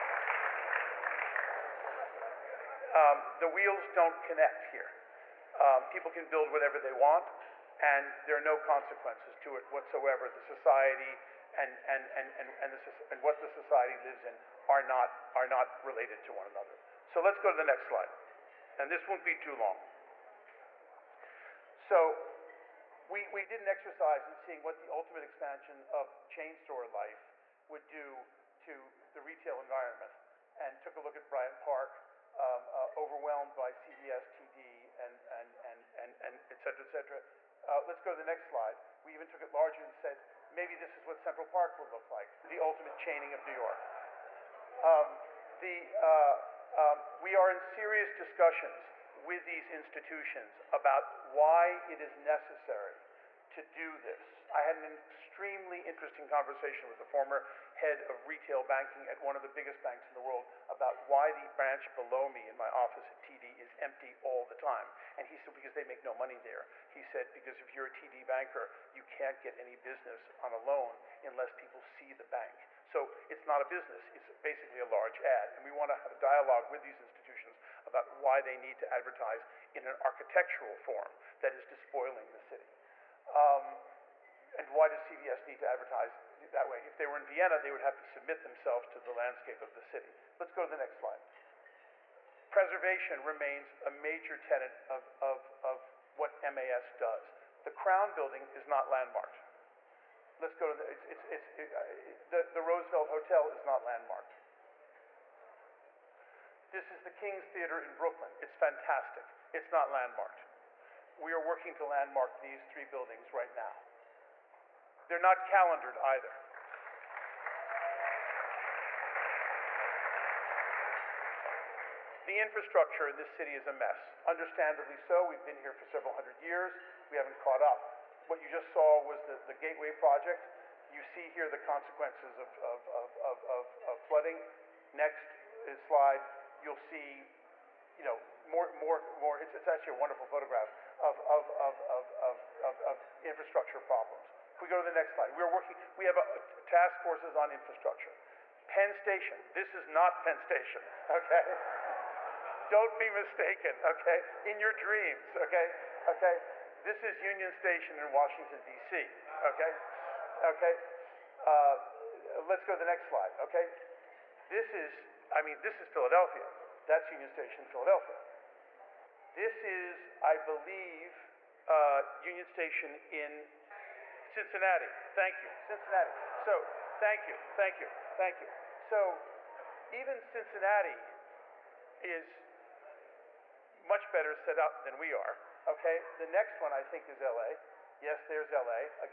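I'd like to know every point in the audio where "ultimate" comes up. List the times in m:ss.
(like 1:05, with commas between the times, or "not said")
0:24, 0:42.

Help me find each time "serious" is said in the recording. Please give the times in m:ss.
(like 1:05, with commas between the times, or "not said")
0:47.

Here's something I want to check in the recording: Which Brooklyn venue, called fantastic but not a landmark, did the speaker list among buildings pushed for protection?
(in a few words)
King's Theater.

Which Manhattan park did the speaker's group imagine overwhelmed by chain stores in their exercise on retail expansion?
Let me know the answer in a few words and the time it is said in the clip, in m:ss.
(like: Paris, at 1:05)
Bryant Park, at 0:31.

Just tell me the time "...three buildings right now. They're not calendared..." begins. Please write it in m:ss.
1:52.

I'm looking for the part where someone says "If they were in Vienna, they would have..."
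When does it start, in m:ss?
1:26.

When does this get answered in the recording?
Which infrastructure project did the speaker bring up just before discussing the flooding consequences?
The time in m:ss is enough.
2:09.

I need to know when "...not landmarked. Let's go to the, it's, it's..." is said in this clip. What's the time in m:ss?
1:38.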